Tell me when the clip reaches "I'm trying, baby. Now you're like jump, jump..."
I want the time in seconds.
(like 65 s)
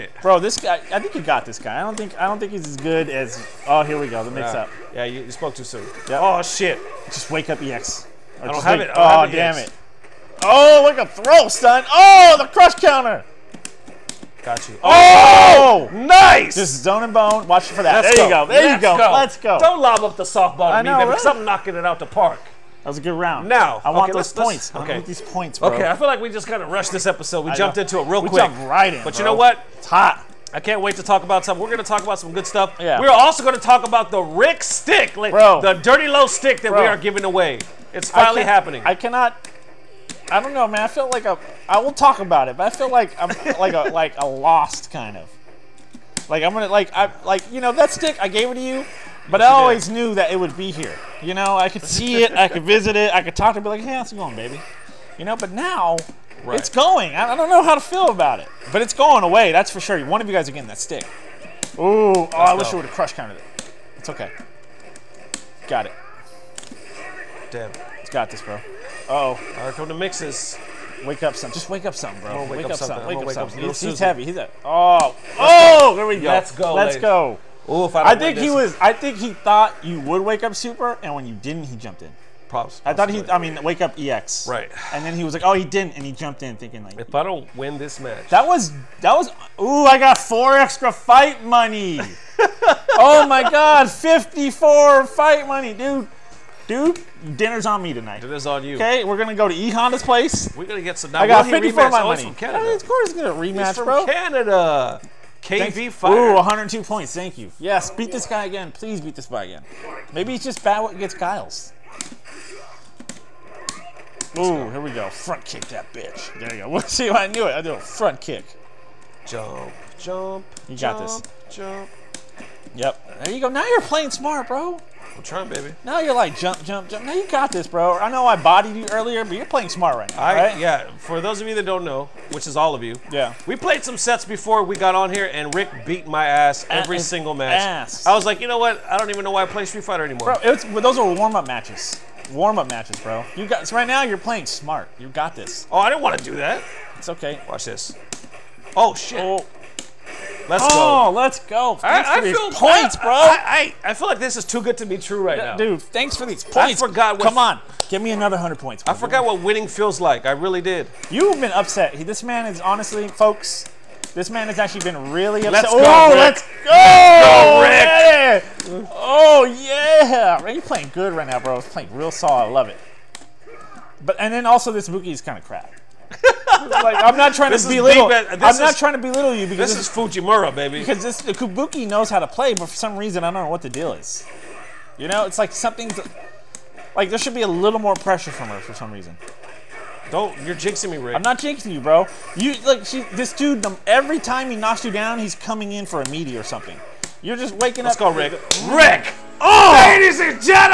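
125 s.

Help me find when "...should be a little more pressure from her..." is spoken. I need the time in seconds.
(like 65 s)
187 s.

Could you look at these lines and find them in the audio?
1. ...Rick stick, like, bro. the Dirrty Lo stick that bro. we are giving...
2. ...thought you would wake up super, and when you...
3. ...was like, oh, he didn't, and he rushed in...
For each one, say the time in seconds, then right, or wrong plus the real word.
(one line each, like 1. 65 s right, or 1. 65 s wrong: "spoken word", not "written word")
1. 34 s right
2. 79 s right
3. 85 s wrong: "jumped", not "rushed".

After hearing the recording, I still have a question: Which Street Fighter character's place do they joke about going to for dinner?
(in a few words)
E Honda.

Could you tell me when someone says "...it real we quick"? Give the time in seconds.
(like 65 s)
27 s.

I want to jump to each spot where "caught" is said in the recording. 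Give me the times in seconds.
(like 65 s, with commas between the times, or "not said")
not said.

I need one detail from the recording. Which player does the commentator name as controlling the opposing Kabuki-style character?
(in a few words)
Fujimura.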